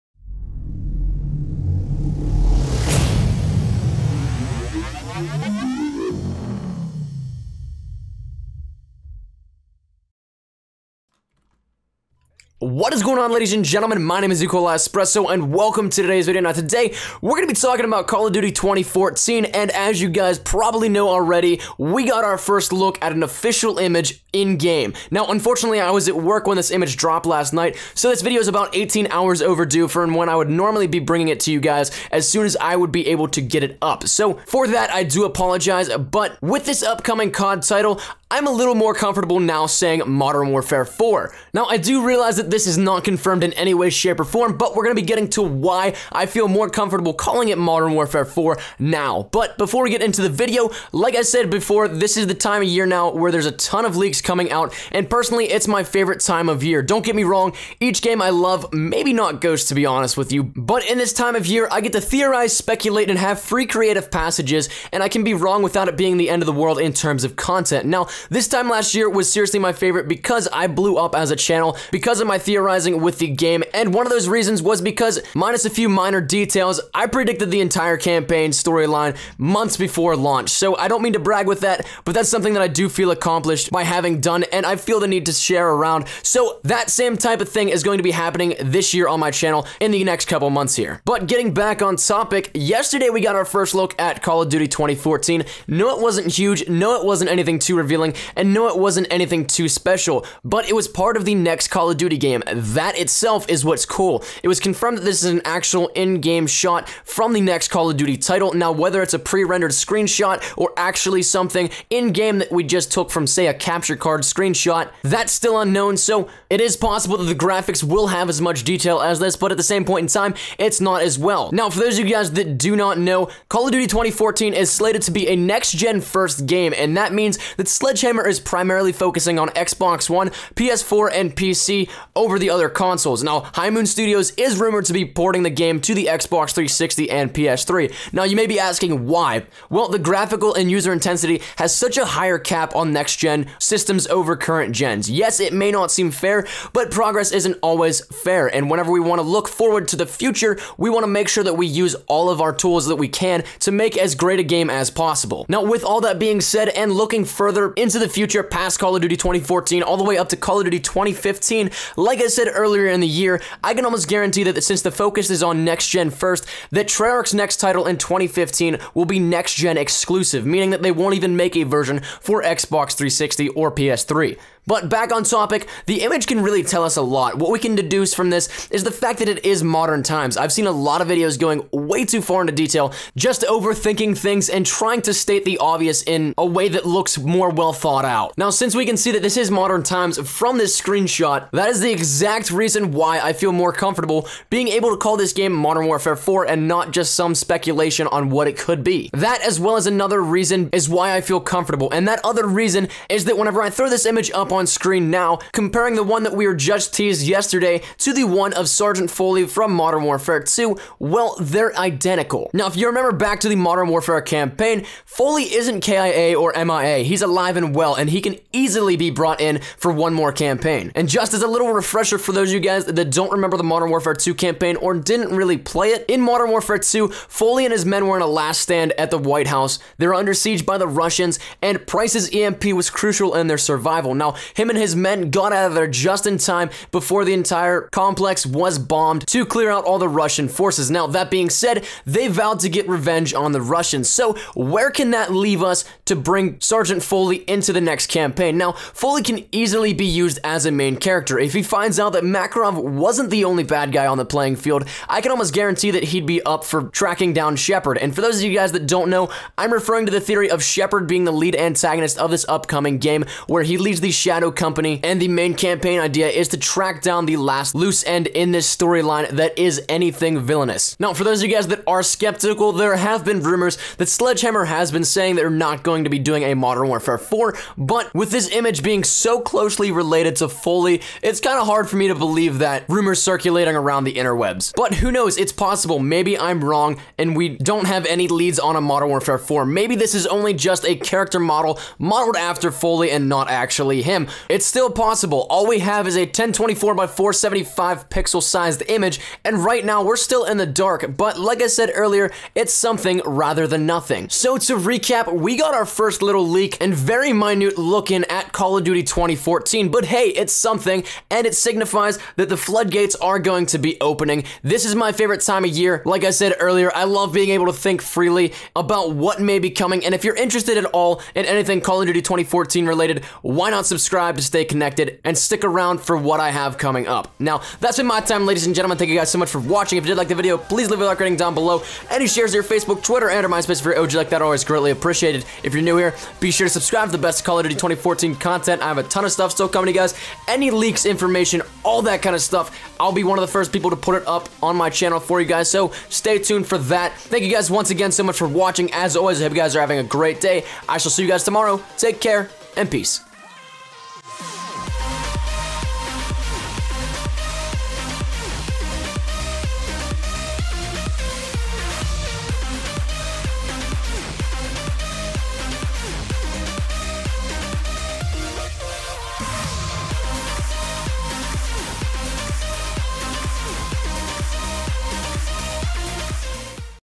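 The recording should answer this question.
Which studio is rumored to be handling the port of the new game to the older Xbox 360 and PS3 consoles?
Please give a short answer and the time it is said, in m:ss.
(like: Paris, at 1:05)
High Moon Studios, at 2:13.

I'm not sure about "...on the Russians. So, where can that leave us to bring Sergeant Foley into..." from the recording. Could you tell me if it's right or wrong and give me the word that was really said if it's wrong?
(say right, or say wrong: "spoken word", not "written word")
right.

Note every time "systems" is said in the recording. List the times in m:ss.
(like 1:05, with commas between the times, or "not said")
2:23.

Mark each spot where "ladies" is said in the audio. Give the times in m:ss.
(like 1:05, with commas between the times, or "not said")
0:13, 5:28.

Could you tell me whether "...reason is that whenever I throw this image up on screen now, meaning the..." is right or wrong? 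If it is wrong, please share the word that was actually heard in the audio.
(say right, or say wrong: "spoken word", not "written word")
wrong: "comparing", not "meaning".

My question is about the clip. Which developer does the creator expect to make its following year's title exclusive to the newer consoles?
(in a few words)
Treyarch.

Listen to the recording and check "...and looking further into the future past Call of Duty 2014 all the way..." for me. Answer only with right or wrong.
right.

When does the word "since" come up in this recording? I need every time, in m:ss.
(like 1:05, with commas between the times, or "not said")
2:44, 3:08.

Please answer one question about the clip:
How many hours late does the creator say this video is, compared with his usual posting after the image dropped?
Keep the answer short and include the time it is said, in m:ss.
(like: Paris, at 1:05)
18, at 0:28.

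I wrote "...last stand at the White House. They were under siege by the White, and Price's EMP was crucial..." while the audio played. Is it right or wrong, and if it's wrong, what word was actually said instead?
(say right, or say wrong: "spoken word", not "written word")
wrong: "Russians", not "White".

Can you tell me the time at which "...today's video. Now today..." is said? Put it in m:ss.
0:16.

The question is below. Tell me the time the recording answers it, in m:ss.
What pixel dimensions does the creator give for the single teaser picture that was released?
4:56.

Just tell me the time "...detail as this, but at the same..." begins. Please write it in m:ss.
1:58.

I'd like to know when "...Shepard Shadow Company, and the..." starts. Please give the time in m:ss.
4:24.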